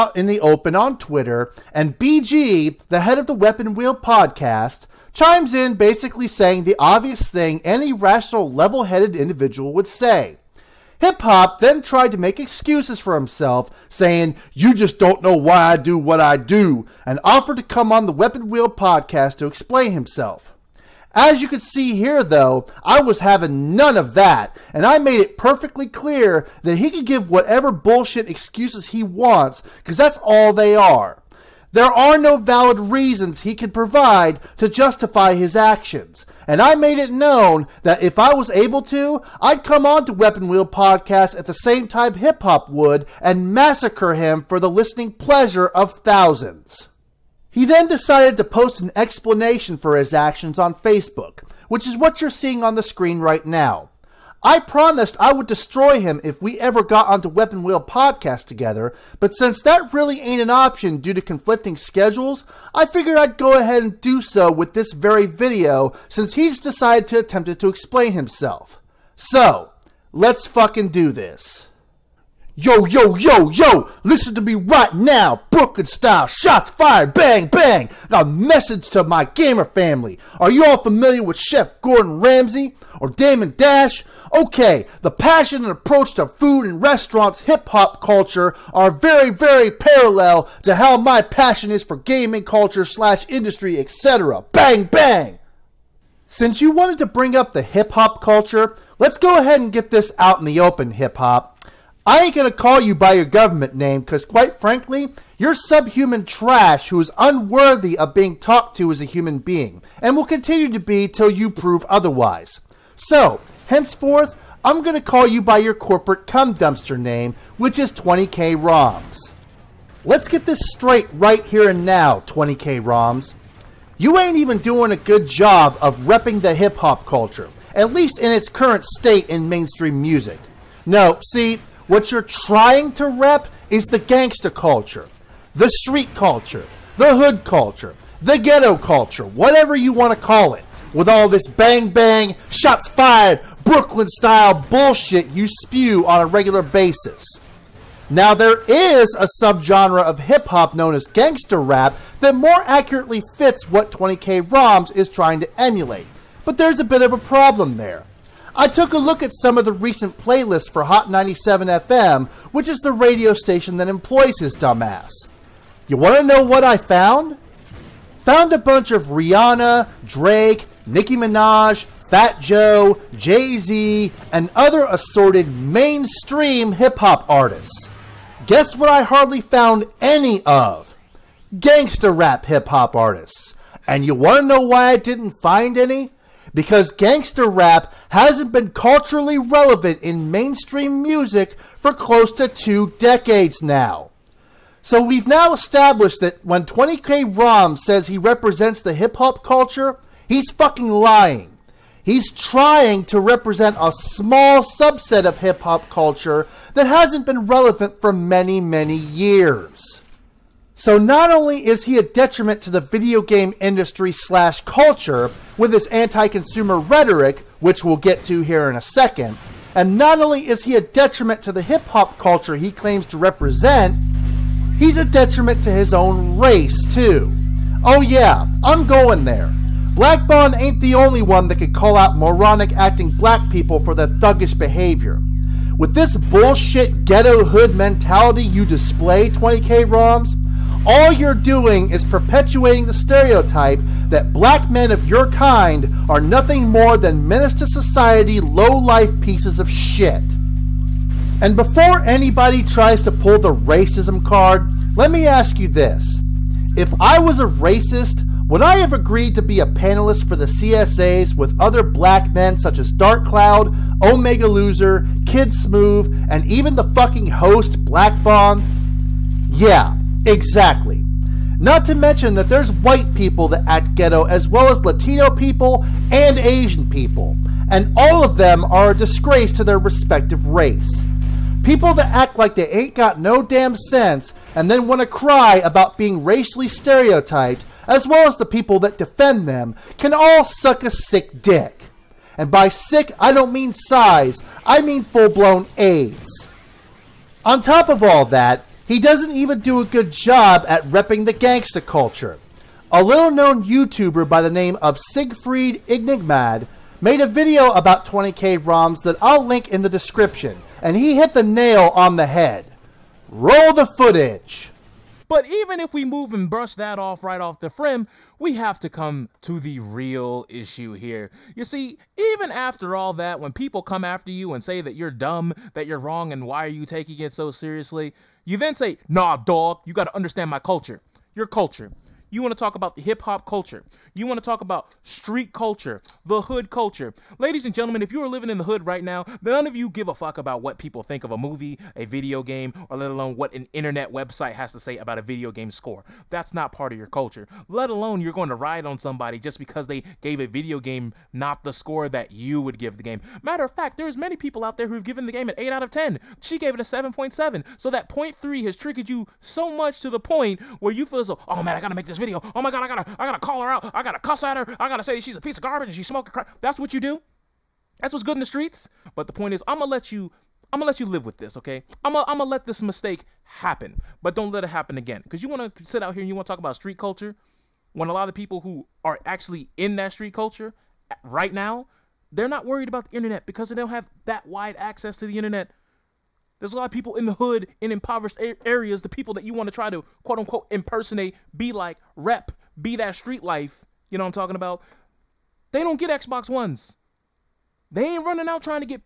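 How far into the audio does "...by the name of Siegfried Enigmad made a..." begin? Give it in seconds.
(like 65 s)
304 s.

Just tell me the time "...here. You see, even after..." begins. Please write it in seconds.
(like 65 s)
320 s.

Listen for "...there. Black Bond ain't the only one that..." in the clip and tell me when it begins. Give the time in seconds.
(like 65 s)
229 s.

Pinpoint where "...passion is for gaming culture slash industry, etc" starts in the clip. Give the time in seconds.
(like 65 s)
91 s.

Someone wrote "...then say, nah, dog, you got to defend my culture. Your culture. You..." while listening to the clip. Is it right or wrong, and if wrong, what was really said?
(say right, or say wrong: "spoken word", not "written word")
wrong: "understand", not "defend".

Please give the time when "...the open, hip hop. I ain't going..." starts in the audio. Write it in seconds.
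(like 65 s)
100 s.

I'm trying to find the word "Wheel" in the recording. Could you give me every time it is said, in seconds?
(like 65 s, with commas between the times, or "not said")
3 s, 18 s, 40 s, 57 s.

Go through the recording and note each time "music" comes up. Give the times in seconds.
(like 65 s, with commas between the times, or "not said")
130 s, 191 s.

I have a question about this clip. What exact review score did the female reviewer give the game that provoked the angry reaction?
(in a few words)
7.7.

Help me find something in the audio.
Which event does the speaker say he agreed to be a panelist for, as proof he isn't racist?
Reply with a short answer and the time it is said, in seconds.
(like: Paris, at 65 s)
CSAs, at 260 s.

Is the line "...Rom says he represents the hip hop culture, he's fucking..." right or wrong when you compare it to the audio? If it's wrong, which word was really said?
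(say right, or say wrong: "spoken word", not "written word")
right.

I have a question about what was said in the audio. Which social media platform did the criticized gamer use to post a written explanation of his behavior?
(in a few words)
Facebook.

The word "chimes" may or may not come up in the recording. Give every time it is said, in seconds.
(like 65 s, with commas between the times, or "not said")
5 s.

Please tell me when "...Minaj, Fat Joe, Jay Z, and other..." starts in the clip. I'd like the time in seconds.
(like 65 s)
171 s.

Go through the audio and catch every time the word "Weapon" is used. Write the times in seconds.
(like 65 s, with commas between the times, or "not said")
3 s, 18 s, 40 s, 57 s.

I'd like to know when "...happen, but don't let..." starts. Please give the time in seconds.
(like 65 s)
373 s.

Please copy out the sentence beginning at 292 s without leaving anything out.
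And by sick, I don't mean size, I mean full blown AIDS.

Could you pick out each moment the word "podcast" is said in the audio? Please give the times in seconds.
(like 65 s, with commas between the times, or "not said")
3 s, 18 s, 40 s, 57 s.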